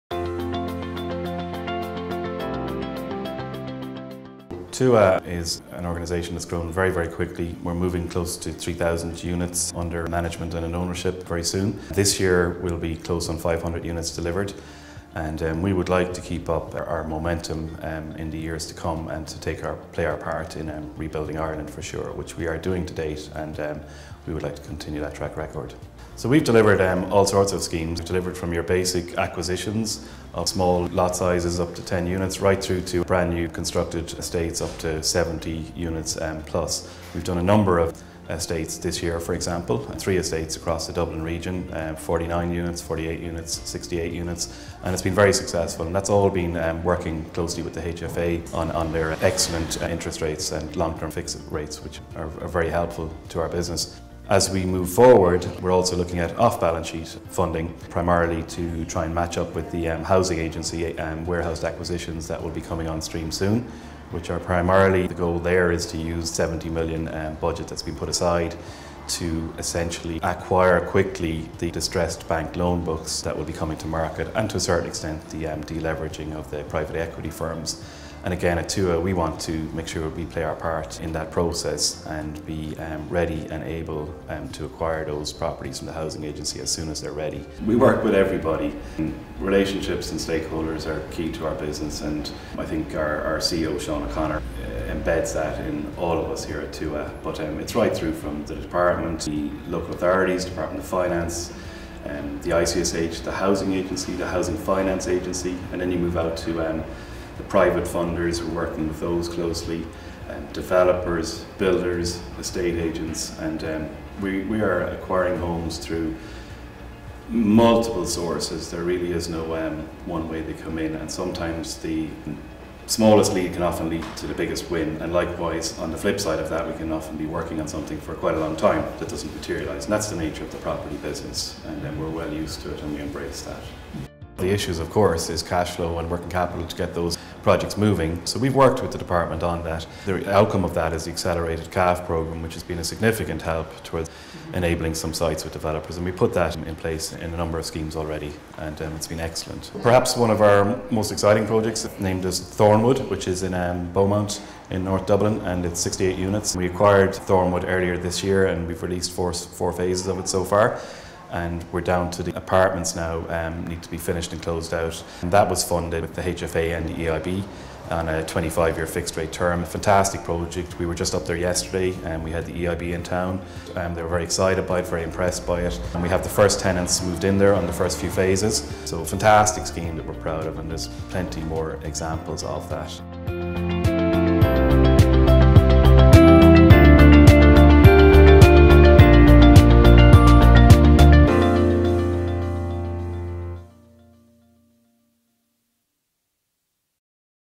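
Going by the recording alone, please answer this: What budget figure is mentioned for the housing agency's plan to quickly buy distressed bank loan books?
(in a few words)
70 million.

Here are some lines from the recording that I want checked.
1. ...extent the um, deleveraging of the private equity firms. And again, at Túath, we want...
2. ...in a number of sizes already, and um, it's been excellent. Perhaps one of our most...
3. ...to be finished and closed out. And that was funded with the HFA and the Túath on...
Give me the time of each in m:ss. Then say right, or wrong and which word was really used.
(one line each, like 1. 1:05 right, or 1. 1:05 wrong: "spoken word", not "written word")
1. 1:14 right
2. 2:27 wrong: "schemes", not "sizes"
3. 2:43 wrong: "EIB", not "Túath".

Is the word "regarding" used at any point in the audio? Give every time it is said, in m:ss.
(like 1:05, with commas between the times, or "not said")
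not said.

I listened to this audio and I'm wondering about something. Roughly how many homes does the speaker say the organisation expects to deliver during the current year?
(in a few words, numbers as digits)
500.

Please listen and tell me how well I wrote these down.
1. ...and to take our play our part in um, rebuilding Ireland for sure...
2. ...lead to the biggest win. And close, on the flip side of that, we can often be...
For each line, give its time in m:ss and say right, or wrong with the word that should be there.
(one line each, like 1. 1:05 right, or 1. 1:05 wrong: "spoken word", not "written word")
1. 0:19 right
2. 2:03 wrong: "likewise", not "close".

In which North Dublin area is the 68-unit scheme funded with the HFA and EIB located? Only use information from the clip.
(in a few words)
Beaumont.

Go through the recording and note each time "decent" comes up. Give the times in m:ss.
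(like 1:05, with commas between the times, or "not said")
not said.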